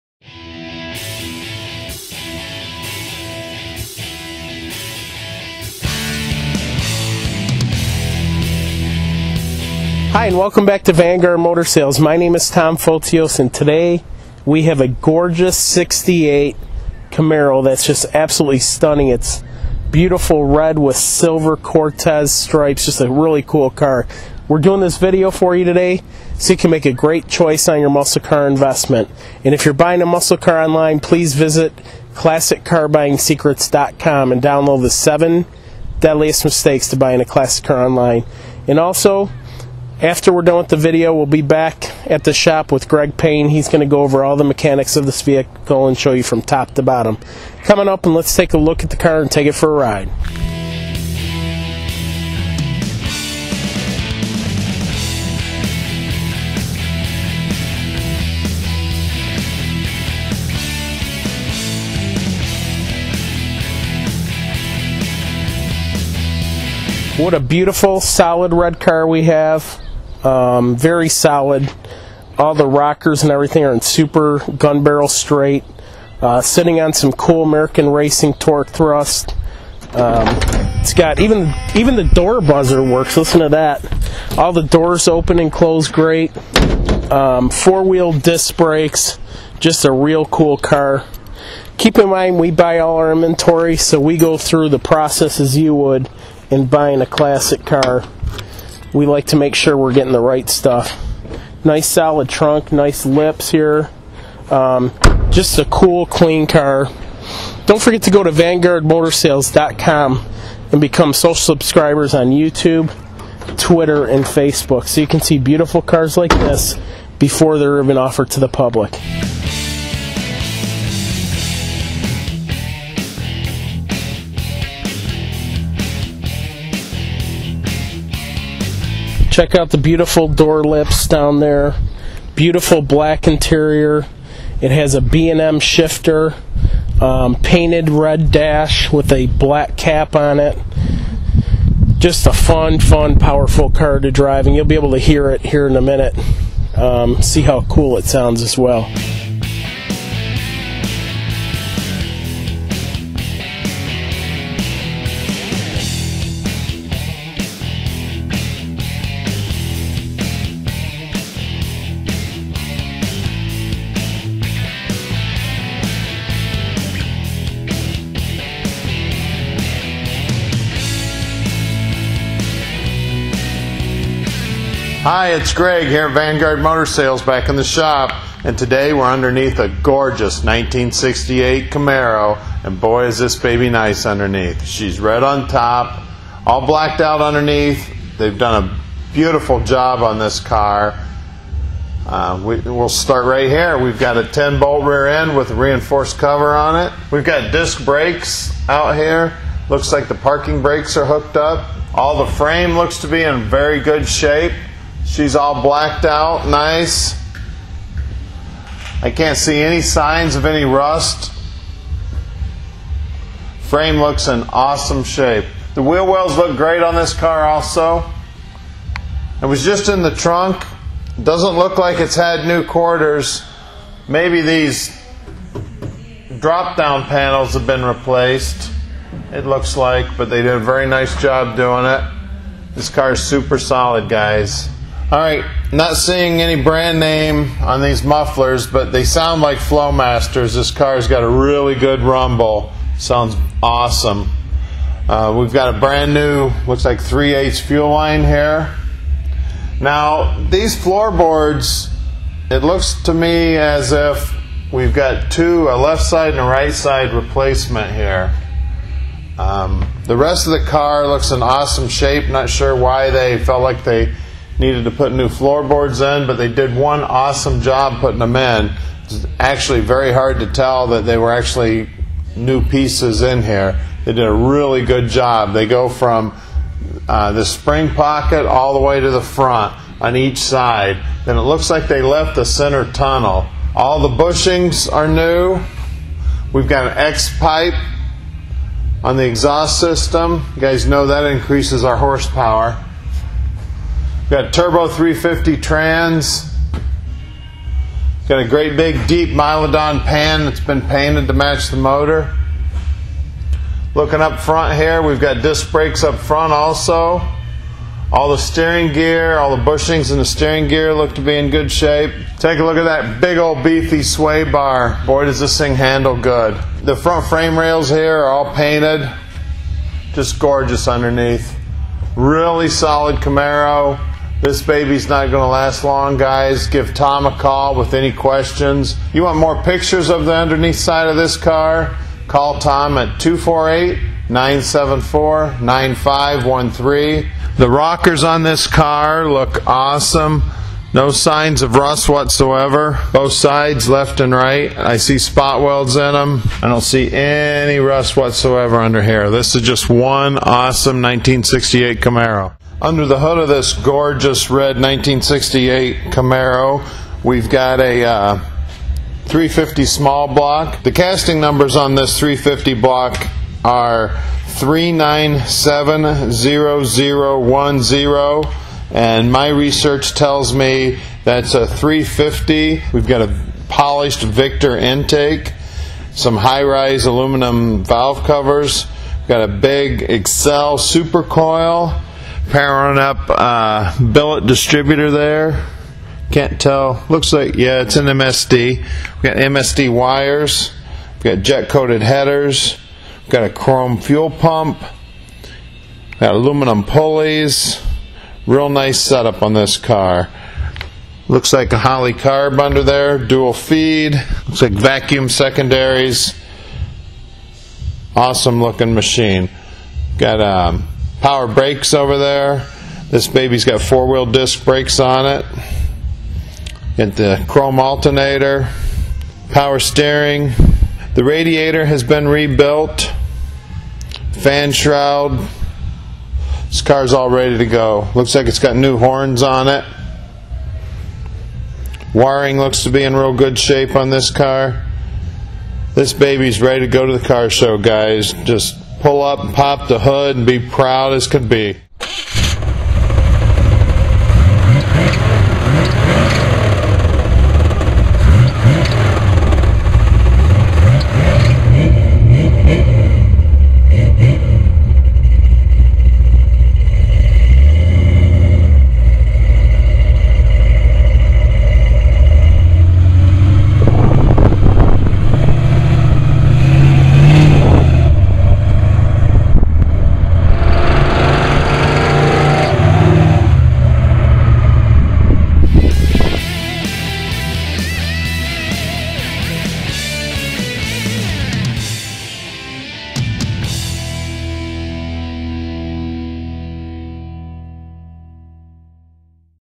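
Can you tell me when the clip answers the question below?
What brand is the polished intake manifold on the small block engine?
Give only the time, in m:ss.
6:14.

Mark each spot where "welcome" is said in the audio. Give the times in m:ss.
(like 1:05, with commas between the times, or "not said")
0:10.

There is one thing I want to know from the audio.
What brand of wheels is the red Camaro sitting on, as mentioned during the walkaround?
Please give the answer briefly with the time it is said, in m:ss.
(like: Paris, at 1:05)
American Racing, at 1:17.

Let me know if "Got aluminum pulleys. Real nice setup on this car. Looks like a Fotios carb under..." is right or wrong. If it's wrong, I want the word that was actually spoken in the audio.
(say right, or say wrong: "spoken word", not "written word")
wrong: "Holley", not "Fotios".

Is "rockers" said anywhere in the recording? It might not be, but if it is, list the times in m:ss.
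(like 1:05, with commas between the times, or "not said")
1:12, 5:37.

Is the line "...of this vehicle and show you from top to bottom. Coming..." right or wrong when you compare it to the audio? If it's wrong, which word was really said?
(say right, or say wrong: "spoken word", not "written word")
right.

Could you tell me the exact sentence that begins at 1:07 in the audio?
What a beautiful, solid red car we have.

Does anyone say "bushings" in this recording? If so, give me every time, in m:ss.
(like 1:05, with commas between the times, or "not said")
4:44, 5:09.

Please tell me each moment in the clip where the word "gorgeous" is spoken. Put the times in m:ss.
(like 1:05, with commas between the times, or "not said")
0:14, 2:59, 5:20, 5:53.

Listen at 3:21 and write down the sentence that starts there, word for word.
All the frame looks to be in very good shape.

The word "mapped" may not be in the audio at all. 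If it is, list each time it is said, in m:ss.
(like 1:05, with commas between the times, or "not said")
not said.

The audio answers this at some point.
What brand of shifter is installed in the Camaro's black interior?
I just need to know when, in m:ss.
2:14.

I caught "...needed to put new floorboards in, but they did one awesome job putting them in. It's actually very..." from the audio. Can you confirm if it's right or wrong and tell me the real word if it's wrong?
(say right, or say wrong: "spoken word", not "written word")
right.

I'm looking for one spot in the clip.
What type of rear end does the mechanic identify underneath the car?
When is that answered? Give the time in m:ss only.
3:14.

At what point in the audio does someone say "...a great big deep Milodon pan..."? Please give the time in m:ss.
4:58.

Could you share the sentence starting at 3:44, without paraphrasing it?
Maybe these drop down panels have been replaced.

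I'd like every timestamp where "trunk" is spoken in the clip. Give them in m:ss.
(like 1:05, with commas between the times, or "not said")
1:42, 3:40.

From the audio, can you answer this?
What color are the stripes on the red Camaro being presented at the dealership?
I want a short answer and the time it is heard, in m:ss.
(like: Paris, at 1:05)
Silver Cortez stripes, at 0:20.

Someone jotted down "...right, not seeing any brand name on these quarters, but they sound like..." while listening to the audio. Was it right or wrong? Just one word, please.
wrong.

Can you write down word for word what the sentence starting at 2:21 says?
Just a fun, fun, powerful car to drive, and you'll be able to hear it here in a minute.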